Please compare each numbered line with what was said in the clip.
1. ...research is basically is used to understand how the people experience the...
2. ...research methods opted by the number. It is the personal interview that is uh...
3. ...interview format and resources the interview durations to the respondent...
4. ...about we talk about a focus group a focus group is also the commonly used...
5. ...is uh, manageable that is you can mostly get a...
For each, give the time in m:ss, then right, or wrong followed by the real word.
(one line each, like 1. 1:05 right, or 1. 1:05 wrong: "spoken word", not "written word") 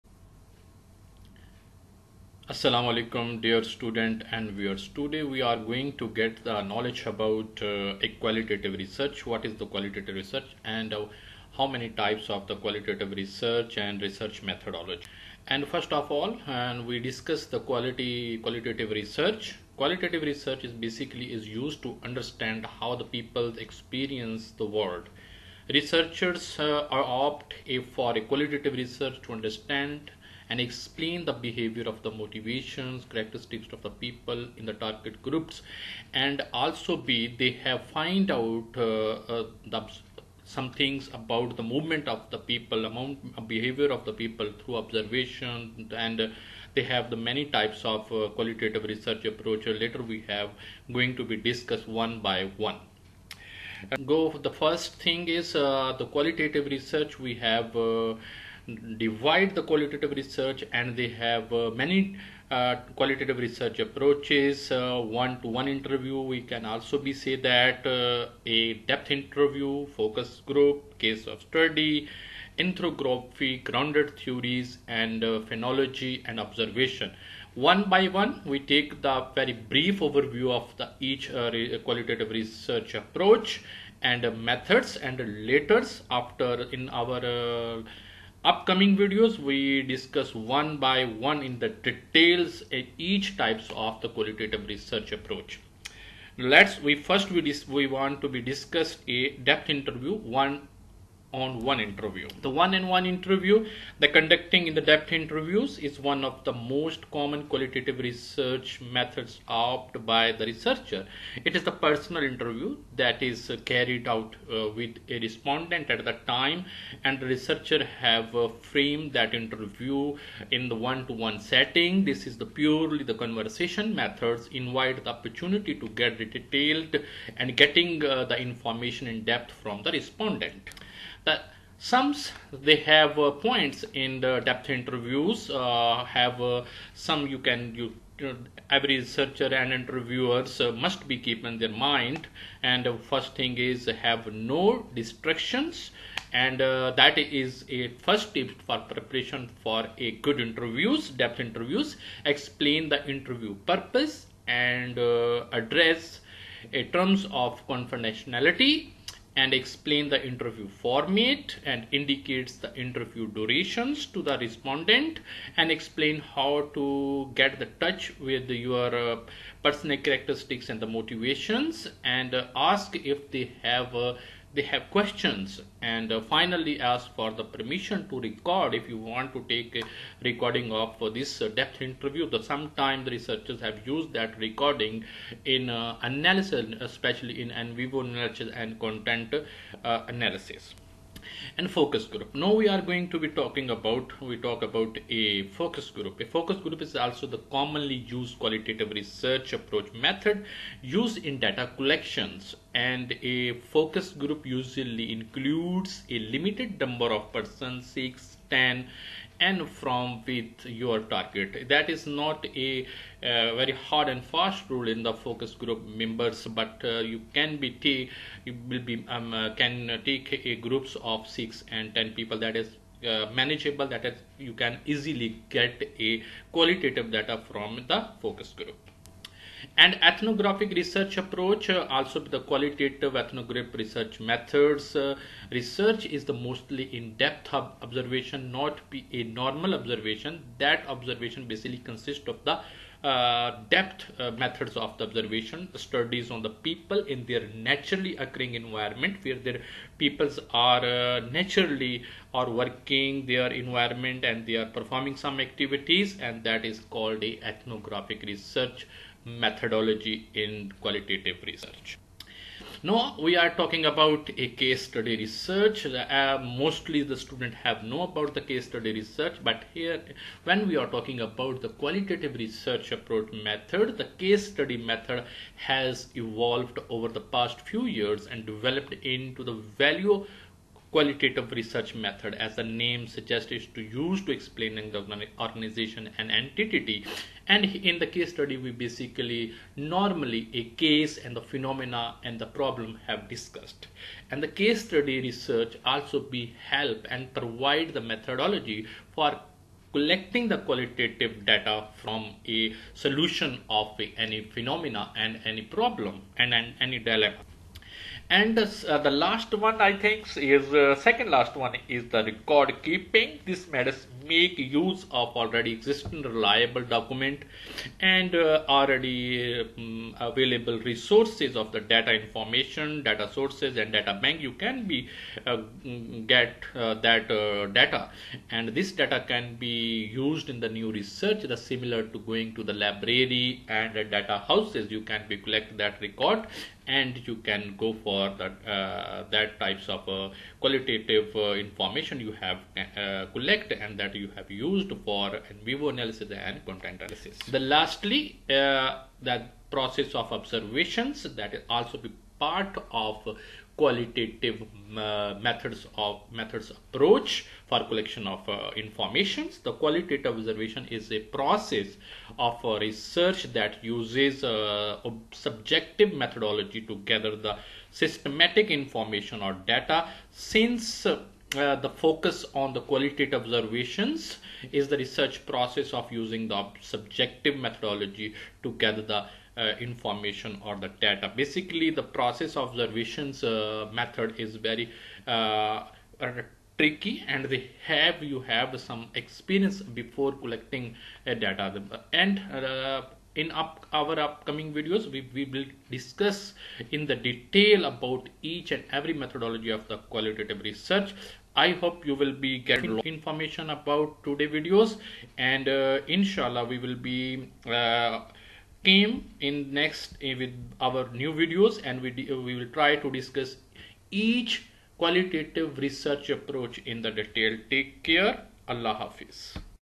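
1. 0:20 right
2. 1:47 wrong: "researcher", not "number"
3. 2:40 wrong: "indicates", not "resources"
4. 3:13 right
5. 3:42 wrong: "easily", not "mostly".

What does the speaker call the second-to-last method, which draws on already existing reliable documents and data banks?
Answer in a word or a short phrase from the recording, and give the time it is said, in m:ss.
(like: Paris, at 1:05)
Record keeping, at 5:12.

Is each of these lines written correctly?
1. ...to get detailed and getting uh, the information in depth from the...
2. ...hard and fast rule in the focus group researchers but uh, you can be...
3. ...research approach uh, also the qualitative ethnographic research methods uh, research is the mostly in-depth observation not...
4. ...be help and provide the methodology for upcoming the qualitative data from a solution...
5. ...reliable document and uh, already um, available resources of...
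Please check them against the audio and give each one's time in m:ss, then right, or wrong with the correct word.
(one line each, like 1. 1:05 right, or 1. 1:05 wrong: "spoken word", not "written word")
1. 2:05 right
2. 3:33 wrong: "members", not "researchers"
3. 3:50 right
4. 4:56 wrong: "collecting", not "upcoming"
5. 5:16 right.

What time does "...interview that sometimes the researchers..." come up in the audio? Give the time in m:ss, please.
3:01.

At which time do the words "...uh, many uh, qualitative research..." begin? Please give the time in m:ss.
1:01.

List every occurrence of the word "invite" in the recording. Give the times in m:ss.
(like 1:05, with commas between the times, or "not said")
2:04.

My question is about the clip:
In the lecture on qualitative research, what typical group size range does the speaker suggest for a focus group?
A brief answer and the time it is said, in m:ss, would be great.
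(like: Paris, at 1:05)
6 to 10 people, at 3:27.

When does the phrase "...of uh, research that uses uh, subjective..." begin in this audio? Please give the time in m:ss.
6:02.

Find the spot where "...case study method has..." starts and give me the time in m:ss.
4:34.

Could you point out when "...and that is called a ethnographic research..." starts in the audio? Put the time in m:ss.
4:16.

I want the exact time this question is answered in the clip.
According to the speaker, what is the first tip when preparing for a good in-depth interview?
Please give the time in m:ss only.
2:24.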